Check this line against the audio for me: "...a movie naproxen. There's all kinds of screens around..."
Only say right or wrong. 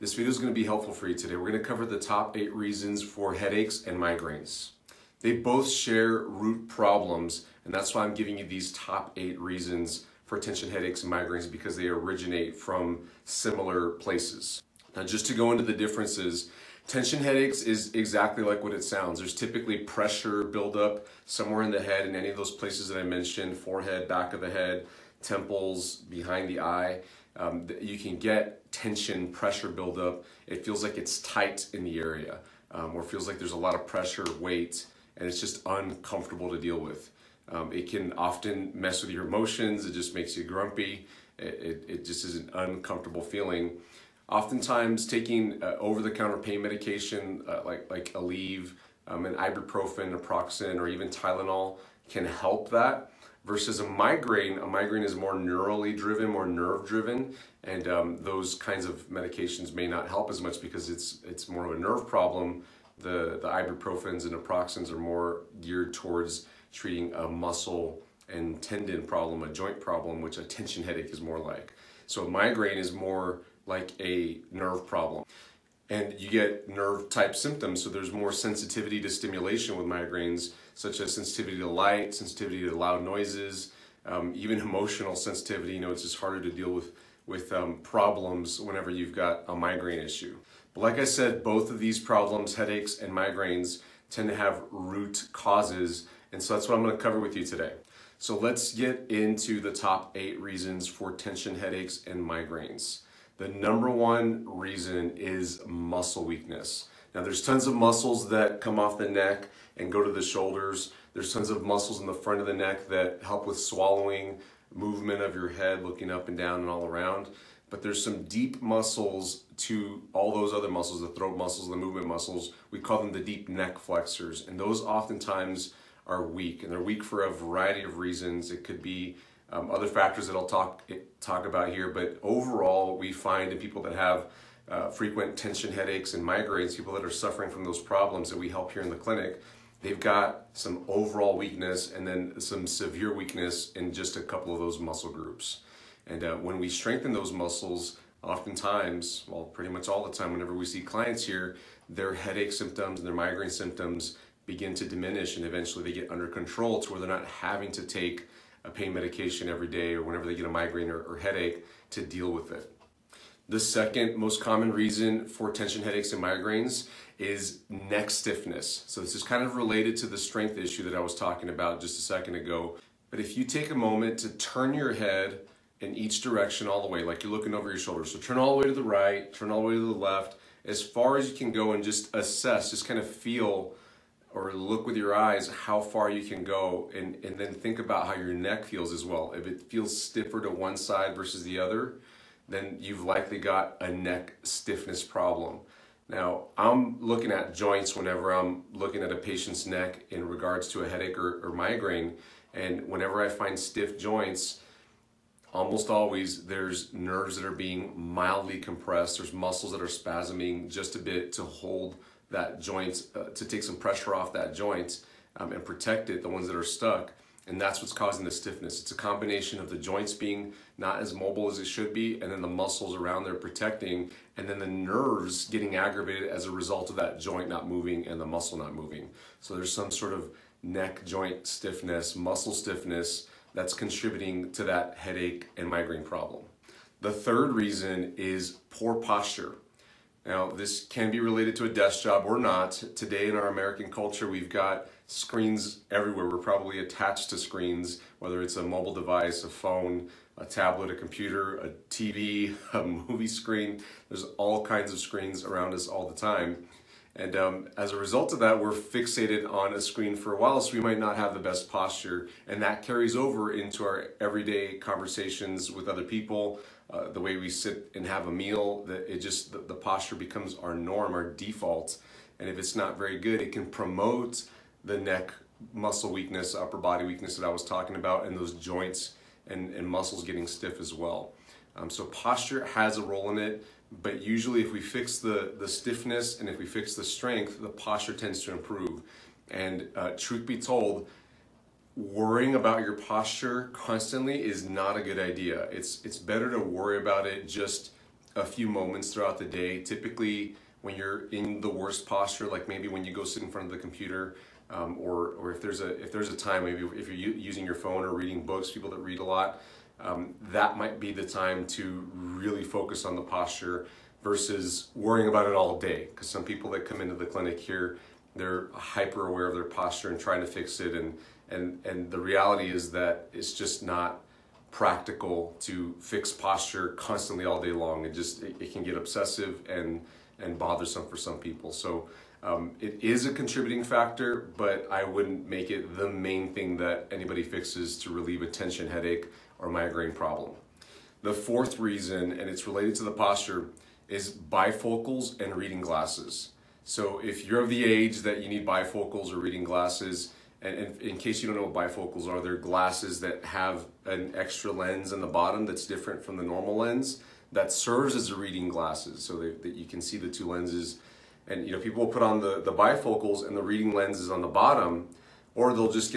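wrong.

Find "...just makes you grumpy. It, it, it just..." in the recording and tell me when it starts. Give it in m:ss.
0:39.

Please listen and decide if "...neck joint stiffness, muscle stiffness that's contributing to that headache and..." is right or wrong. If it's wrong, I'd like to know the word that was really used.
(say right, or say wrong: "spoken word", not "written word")
right.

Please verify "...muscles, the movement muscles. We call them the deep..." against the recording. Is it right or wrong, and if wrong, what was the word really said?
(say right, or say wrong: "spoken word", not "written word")
right.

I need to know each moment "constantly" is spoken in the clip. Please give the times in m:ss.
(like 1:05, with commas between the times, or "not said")
4:53, 5:26.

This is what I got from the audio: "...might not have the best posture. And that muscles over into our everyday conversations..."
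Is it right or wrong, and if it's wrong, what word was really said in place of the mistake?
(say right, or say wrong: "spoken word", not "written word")
wrong: "carries", not "muscles".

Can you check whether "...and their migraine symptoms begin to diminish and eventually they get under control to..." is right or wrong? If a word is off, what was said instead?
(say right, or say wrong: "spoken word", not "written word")
right.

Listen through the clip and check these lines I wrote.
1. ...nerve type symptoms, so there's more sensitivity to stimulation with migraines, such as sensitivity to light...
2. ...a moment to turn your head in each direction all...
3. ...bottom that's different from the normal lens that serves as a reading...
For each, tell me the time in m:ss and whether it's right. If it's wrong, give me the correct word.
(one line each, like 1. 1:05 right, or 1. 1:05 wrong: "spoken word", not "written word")
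1. 1:16 right
2. 2:53 right
3. 5:55 right.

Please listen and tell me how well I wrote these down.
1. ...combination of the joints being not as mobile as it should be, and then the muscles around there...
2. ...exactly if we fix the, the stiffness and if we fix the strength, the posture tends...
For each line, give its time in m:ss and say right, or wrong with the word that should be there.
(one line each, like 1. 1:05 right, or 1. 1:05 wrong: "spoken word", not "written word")
1. 3:38 right
2. 4:44 wrong: "usually", not "exactly".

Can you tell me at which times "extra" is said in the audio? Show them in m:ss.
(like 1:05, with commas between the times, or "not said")
5:54.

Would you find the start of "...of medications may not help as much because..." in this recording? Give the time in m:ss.
0:58.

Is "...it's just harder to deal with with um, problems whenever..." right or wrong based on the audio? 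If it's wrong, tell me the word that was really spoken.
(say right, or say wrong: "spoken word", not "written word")
right.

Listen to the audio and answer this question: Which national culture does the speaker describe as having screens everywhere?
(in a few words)
American.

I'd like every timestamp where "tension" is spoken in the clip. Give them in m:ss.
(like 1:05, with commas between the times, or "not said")
0:10, 0:16, 0:28, 1:10, 1:41, 2:15, 2:45, 5:38.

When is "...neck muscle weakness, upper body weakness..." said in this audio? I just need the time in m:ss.
4:34.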